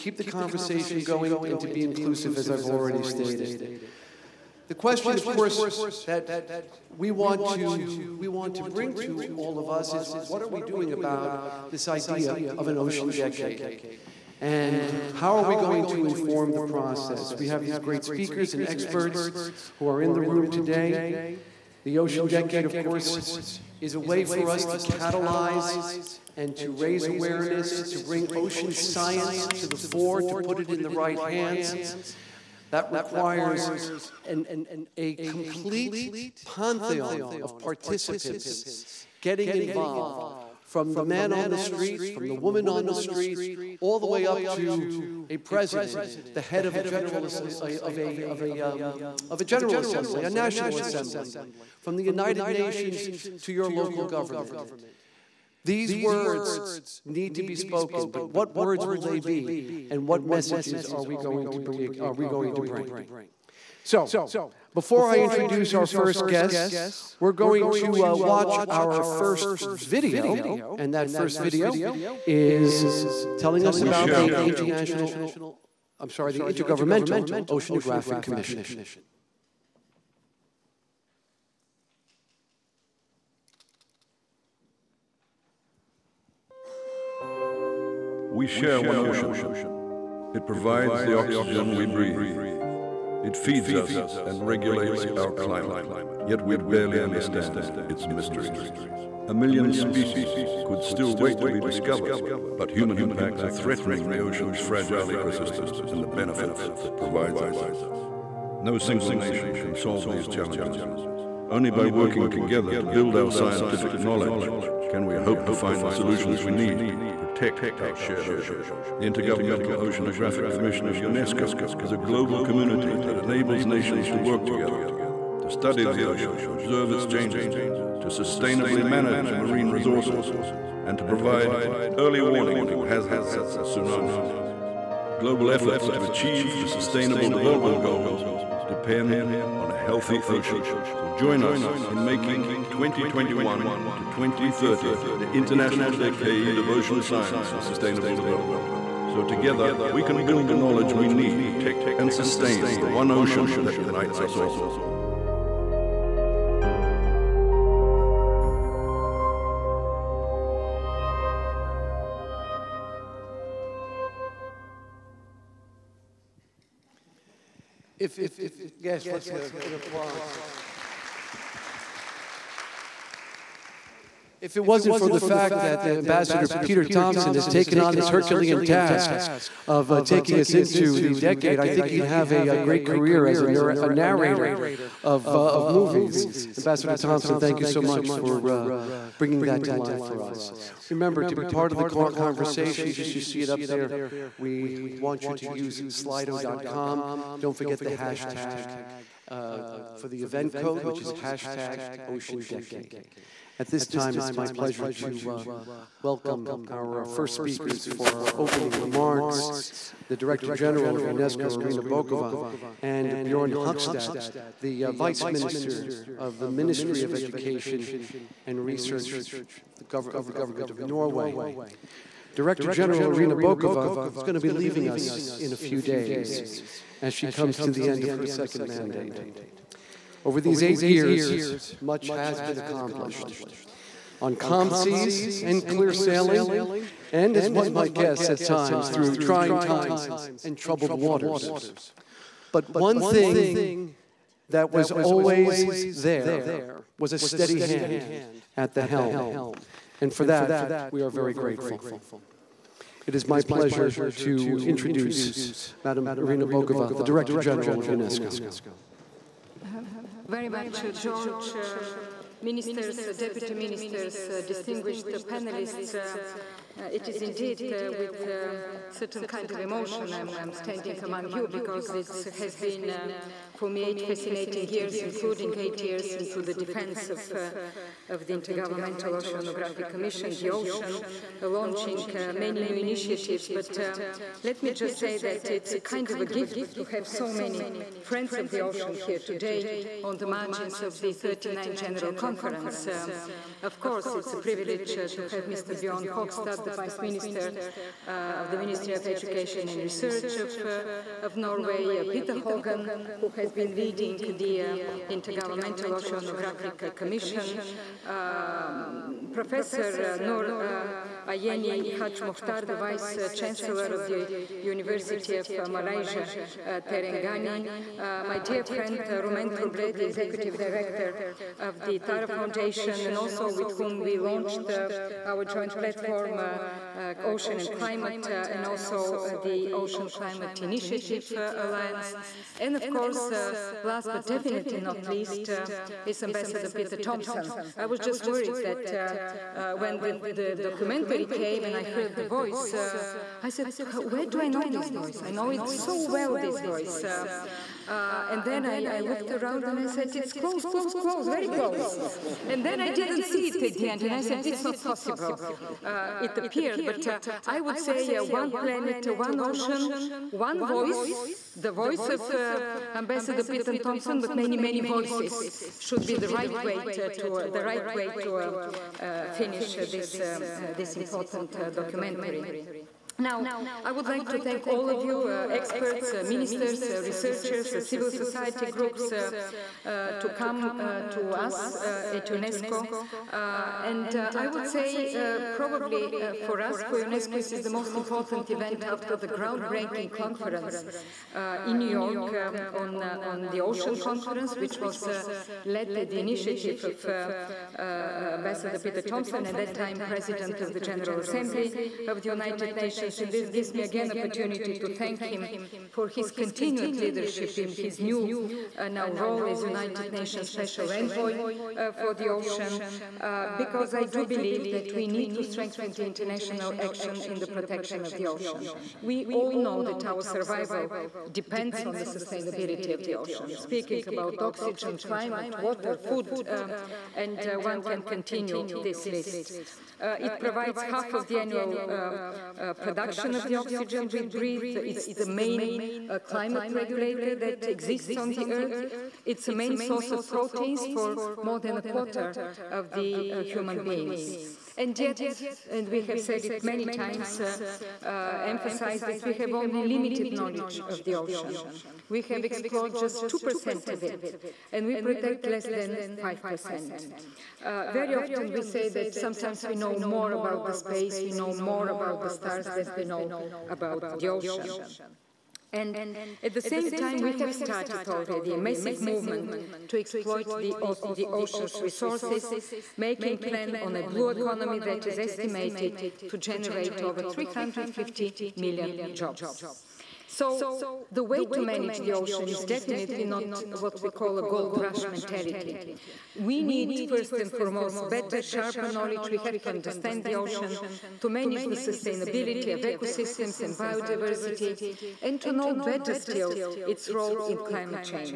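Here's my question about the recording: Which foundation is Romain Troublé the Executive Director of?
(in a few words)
Tara Foundation.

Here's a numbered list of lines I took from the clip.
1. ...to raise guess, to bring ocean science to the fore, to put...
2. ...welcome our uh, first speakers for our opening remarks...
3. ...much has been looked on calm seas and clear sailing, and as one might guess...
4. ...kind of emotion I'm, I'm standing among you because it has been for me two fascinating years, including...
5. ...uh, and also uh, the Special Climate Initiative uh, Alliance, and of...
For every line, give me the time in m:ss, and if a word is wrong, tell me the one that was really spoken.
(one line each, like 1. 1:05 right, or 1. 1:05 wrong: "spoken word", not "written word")
1. 0:26 wrong: "awareness", not "guess"
2. 3:26 right
3. 3:51 wrong: "accomplished", not "looked"
4. 4:29 wrong: "eight", not "two"
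5. 5:28 wrong: "Ocean", not "Special".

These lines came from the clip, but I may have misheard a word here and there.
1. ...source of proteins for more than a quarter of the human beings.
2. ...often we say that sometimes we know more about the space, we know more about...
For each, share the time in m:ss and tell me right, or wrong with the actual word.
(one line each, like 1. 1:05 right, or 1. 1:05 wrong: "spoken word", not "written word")
1. 7:19 right
2. 7:38 right.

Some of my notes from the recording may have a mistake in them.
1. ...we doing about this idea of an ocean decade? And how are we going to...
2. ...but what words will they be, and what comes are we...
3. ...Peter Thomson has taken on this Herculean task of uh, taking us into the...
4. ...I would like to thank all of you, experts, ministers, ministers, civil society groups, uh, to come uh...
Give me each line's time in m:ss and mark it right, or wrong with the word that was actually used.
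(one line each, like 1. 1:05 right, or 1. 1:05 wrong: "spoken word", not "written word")
1. 0:10 right
2. 0:58 wrong: "messages", not "comes"
3. 2:56 right
4. 6:13 wrong: "researchers", not "ministers".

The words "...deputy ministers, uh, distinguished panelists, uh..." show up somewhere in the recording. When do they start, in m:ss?
4:23.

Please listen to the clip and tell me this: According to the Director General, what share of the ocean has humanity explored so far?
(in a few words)
2%.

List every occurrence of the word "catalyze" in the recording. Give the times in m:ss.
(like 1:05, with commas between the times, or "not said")
0:24.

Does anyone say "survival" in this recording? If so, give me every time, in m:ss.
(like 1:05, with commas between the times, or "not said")
7:00.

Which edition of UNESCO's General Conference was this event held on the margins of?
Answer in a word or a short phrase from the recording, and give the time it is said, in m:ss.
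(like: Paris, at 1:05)
39th, at 4:51.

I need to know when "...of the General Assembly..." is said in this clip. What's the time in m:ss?
6:40.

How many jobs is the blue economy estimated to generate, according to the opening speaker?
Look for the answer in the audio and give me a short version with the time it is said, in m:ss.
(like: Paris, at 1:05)
350 million, at 7:57.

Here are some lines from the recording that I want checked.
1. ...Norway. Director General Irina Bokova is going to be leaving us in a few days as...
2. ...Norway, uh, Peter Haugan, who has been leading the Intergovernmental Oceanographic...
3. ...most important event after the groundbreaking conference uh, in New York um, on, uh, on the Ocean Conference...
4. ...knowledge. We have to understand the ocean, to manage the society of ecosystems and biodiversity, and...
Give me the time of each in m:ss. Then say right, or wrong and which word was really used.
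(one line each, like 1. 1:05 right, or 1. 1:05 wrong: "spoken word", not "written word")
1. 3:40 right
2. 5:01 right
3. 6:27 right
4. 8:08 wrong: "sustainability", not "society".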